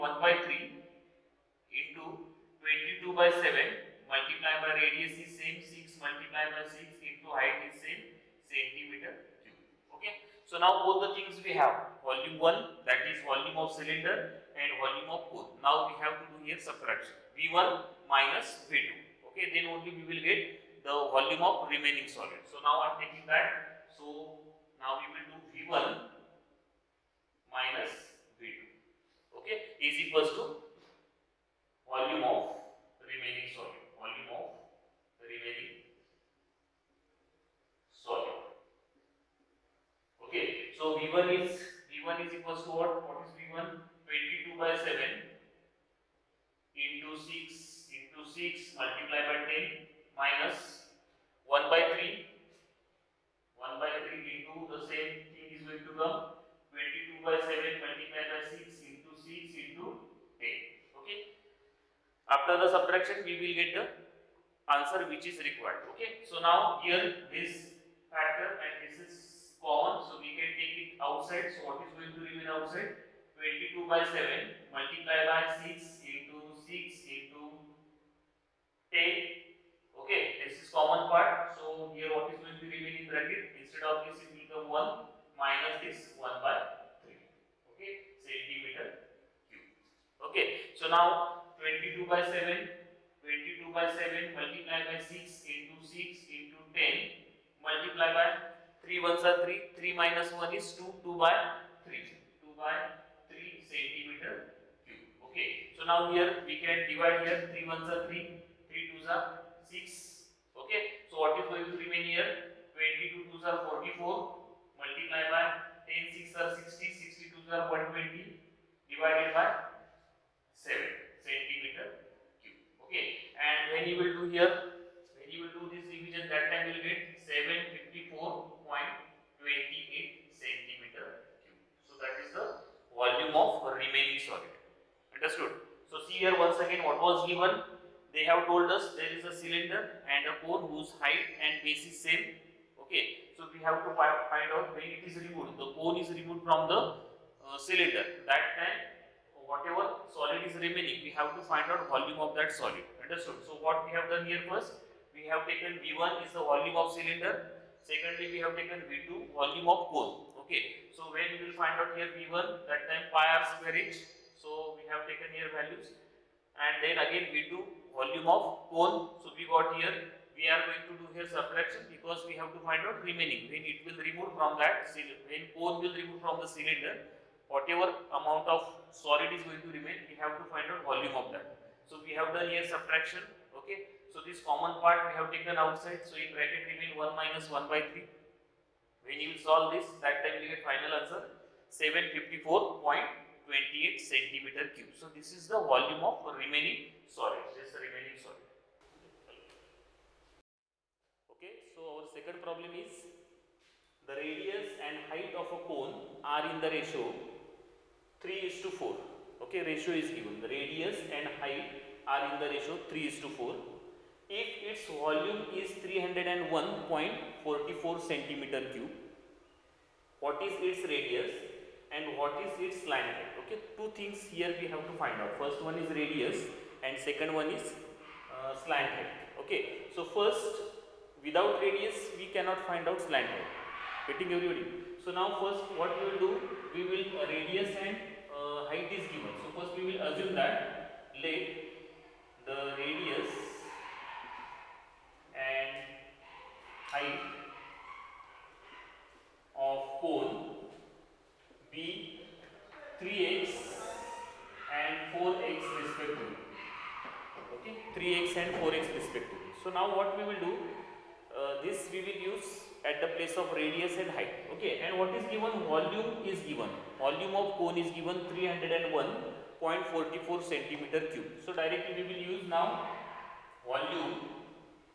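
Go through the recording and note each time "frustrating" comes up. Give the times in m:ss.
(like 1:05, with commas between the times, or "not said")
not said.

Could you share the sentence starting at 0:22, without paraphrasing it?
So now I am taking that.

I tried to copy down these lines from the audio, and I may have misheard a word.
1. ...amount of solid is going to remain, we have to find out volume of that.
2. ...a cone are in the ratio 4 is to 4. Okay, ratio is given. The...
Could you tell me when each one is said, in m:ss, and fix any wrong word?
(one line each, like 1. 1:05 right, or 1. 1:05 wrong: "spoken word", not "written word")
1. 2:58 right
2. 3:25 wrong: "3", not "4".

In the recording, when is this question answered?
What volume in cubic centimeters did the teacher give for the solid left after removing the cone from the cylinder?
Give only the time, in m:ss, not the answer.
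3:12.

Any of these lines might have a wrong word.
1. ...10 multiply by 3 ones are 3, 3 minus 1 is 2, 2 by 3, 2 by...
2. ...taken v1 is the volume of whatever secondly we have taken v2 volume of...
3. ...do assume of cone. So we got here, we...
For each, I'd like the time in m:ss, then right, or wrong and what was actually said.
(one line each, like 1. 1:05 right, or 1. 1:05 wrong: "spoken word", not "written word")
1. 1:36 right
2. 2:35 wrong: "cylinder", not "whatever"
3. 2:47 wrong: "volume", not "assume".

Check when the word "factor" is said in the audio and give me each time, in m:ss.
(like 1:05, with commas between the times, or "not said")
1:08.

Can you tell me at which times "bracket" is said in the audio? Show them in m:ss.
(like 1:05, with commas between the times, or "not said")
1:23, 3:06.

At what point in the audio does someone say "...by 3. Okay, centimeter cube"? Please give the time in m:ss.
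1:26.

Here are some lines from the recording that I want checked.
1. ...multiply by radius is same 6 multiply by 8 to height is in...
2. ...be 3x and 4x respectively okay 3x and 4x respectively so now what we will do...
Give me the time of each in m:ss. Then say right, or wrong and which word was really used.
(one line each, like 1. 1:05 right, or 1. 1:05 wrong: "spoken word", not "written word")
1. 0:04 wrong: "6", not "8"
2. 4:11 right.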